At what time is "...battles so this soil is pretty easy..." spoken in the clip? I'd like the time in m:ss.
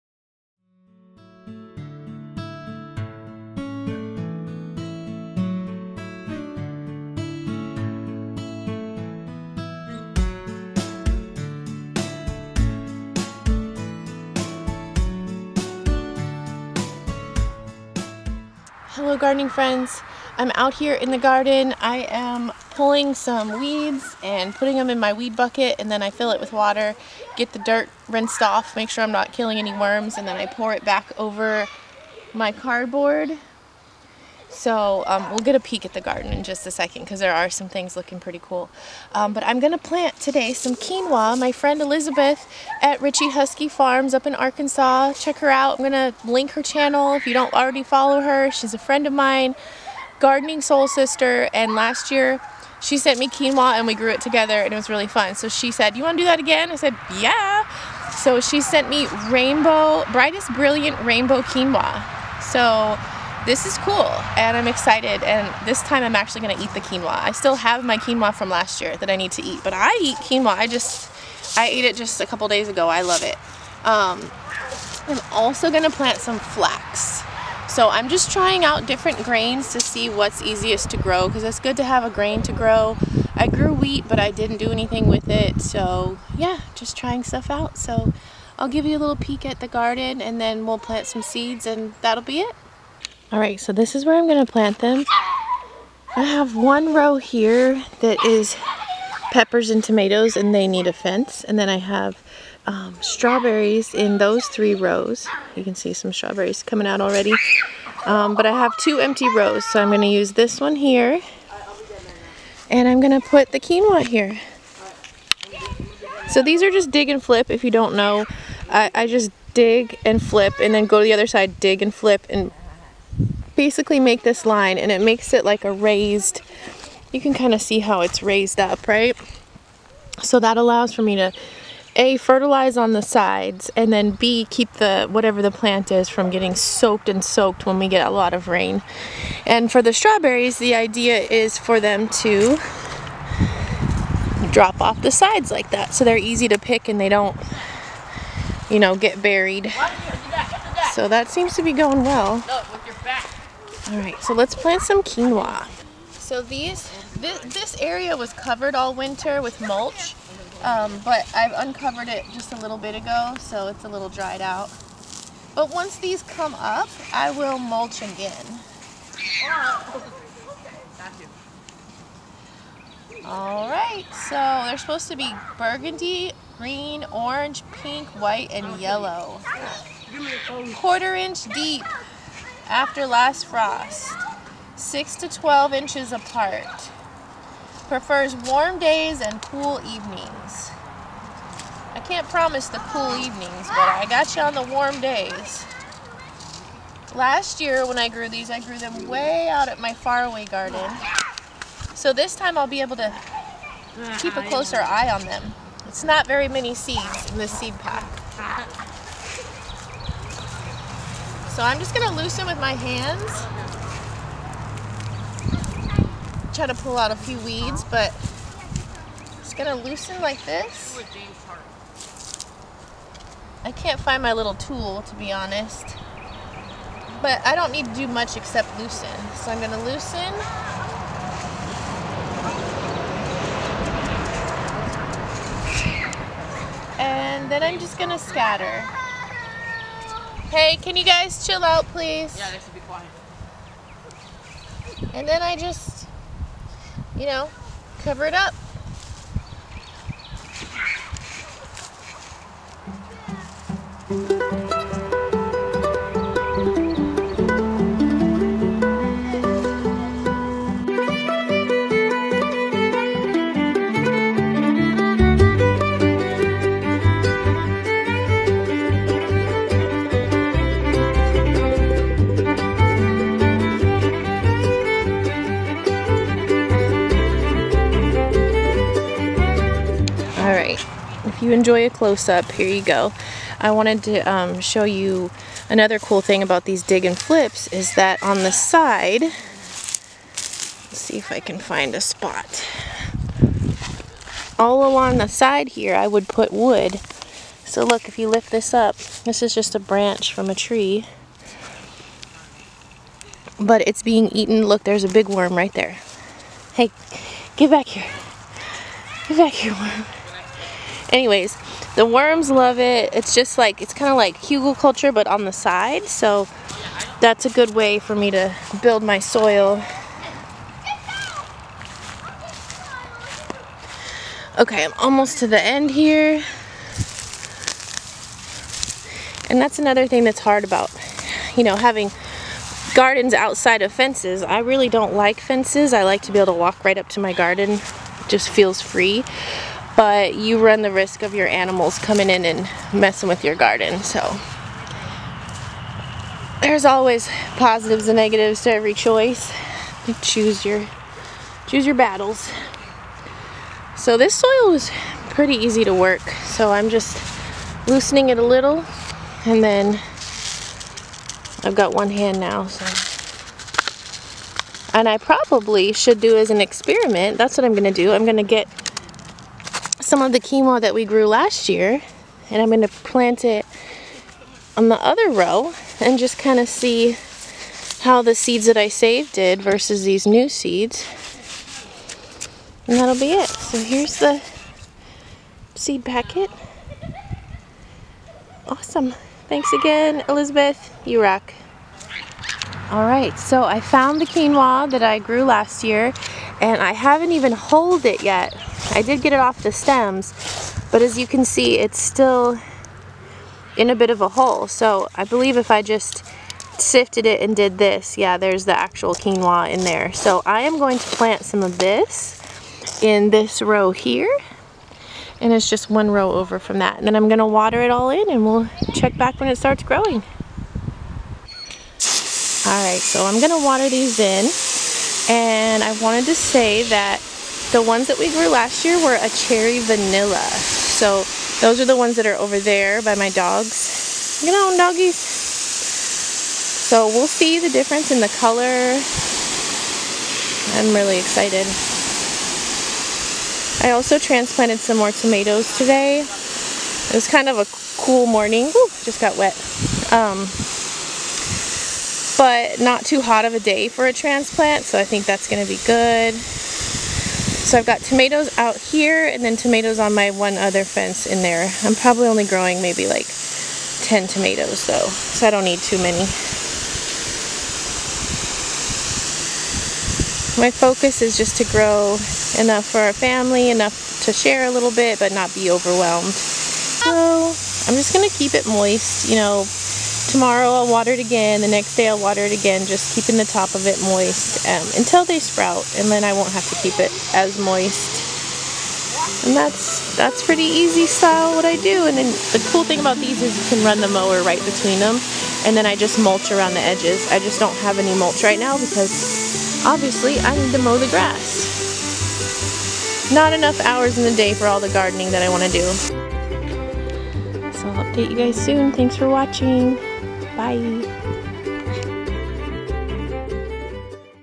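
5:51.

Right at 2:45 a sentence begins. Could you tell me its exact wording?
But once these come up, I will mulch again.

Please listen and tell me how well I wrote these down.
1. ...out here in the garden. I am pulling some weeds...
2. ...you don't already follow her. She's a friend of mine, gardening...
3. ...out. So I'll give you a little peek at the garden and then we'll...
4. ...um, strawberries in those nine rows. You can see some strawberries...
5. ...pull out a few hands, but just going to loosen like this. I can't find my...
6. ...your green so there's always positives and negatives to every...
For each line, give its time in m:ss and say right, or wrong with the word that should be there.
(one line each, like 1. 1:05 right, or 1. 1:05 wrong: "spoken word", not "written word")
1. 0:20 right
2. 0:47 right
3. 1:27 right
4. 1:42 wrong: "three", not "nine"
5. 3:36 wrong: "weeds", not "hands"
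6. 5:43 wrong: "garden", not "green".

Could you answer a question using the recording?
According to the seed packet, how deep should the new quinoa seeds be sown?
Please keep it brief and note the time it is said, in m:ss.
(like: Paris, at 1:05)
Quarter inch, at 3:00.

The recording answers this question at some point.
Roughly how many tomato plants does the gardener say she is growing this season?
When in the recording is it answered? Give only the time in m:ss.
7:44.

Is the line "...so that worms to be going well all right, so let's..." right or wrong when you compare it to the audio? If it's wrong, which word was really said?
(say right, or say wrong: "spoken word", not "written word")
wrong: "seems", not "worms".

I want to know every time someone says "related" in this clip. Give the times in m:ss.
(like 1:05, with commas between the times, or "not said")
not said.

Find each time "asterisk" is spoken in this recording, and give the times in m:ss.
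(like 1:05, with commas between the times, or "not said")
not said.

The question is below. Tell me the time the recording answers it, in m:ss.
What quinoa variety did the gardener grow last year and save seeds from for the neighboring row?
7:09.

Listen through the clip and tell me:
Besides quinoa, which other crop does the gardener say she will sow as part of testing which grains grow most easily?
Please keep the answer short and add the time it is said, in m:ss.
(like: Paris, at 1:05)
Flax, at 1:16.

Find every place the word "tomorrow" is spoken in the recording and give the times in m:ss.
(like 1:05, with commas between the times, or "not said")
8:00.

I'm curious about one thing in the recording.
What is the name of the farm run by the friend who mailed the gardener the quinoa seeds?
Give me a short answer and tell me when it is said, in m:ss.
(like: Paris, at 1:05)
Richey Huskey Farms, at 0:43.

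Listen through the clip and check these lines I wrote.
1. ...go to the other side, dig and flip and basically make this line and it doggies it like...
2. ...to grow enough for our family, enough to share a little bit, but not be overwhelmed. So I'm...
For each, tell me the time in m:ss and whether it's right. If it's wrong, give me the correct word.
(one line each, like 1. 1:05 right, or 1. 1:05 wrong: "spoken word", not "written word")
1. 2:00 wrong: "makes", not "doggies"
2. 7:51 right.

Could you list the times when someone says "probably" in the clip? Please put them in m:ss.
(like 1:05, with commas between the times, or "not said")
6:05, 7:41.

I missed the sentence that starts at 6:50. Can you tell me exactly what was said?
So I am going to plant some of this in this row here.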